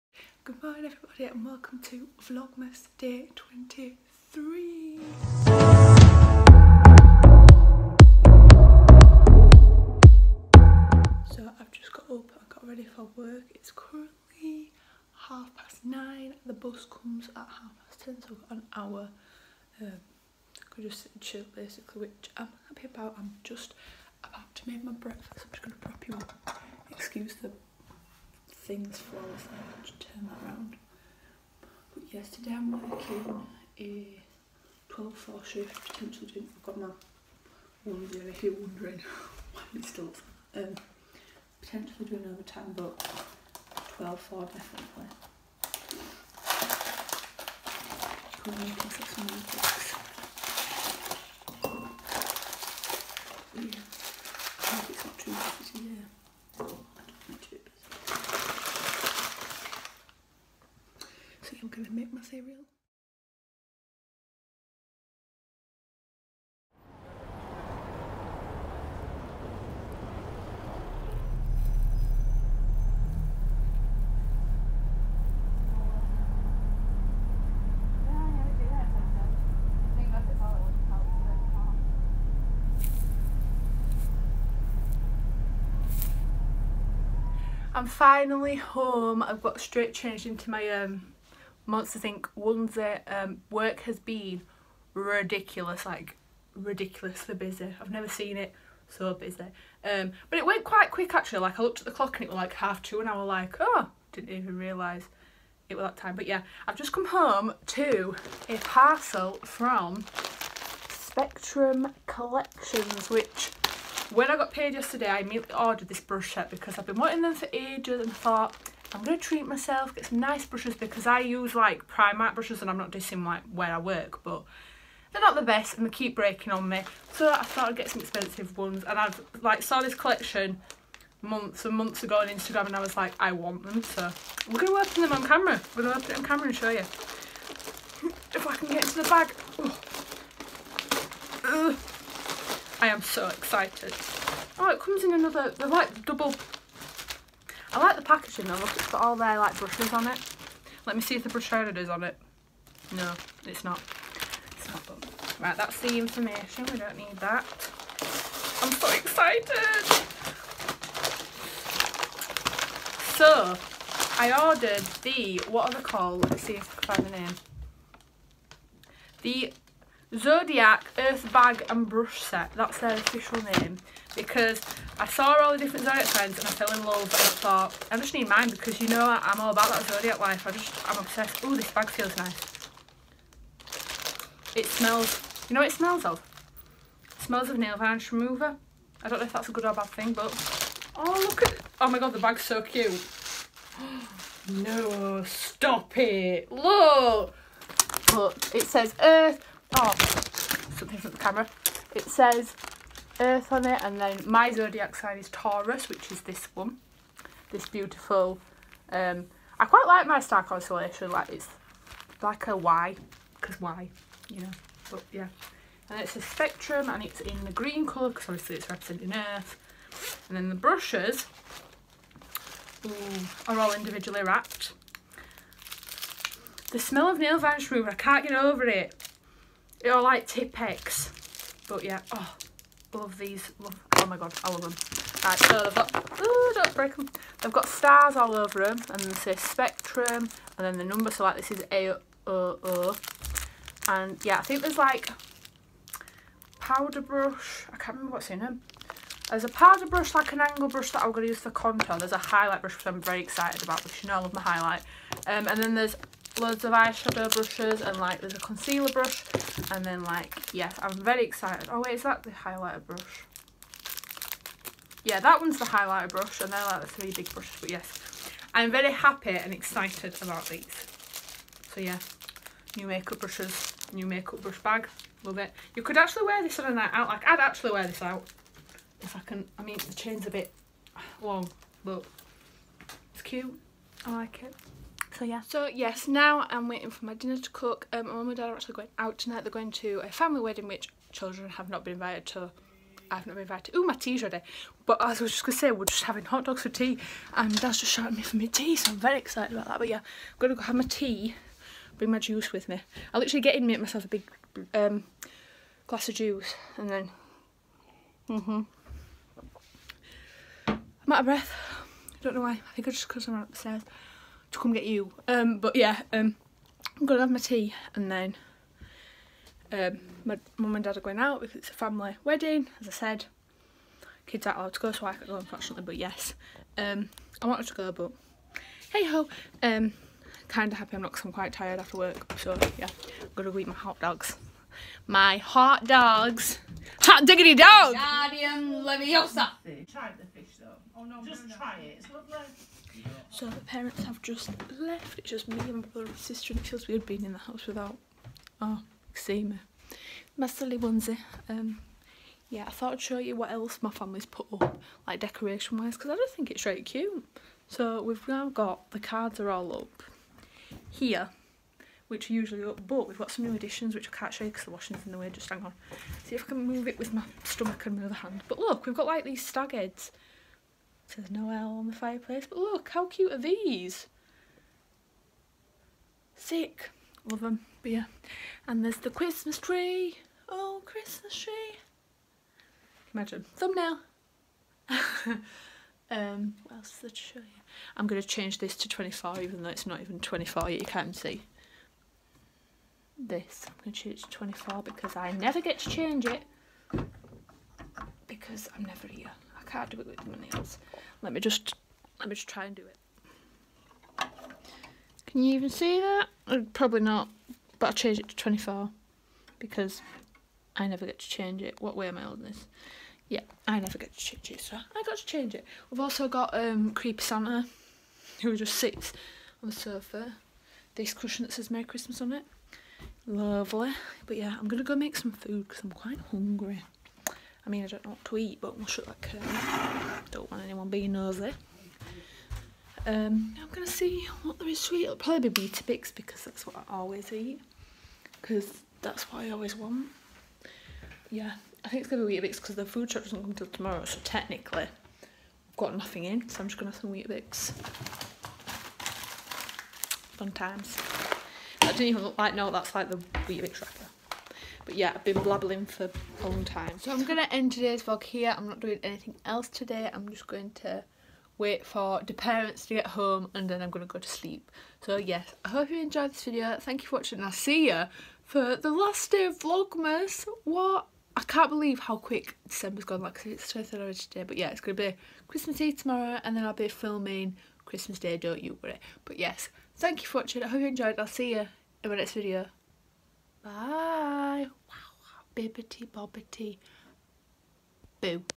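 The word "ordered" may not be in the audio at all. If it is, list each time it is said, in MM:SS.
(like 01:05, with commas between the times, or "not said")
01:55, 02:44.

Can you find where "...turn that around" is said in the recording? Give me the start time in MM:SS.
00:29.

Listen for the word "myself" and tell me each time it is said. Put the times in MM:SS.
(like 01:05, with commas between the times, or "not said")
01:59, 05:03.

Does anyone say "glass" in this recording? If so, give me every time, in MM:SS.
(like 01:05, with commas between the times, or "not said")
05:05.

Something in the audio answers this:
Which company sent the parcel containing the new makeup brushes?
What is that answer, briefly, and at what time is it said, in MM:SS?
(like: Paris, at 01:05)
Spectrum Collections, at 01:50.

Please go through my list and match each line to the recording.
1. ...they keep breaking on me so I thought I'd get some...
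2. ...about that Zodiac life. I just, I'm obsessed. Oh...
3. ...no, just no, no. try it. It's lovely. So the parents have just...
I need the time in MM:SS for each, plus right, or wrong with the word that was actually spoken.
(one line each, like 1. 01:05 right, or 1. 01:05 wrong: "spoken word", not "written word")
1. 02:05 right
2. 02:59 right
3. 05:41 right.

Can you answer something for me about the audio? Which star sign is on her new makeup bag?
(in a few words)
Taurus.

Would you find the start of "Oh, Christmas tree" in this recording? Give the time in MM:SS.
06:20.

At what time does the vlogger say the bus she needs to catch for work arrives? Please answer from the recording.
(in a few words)
half past ten.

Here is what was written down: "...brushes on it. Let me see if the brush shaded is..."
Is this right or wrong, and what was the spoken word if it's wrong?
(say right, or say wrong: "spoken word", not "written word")
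right.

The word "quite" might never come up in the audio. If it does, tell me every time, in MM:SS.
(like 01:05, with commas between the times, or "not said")
01:40, 03:29, 05:31, 07:05.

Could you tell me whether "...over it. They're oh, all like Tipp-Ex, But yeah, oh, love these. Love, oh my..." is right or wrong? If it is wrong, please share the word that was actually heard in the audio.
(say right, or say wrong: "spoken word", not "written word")
right.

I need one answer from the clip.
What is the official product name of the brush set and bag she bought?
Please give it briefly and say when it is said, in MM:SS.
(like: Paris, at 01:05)
Zodiac Earth Bag and Brush Set, at 02:49.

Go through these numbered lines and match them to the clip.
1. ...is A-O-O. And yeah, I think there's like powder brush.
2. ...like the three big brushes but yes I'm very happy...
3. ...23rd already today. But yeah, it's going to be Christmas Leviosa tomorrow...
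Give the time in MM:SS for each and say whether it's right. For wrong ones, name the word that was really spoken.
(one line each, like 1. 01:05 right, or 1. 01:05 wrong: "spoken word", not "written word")
1. 04:01 right
2. 04:26 right
3. 07:53 wrong: "Eve", not "Leviosa".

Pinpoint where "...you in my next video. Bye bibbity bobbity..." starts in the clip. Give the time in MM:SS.
08:01.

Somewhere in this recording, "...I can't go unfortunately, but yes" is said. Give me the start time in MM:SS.
05:25.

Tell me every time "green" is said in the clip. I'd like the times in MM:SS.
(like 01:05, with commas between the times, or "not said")
03:37.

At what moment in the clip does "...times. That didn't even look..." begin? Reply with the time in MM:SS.
07:30.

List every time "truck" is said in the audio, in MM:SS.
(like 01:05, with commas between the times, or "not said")
07:23.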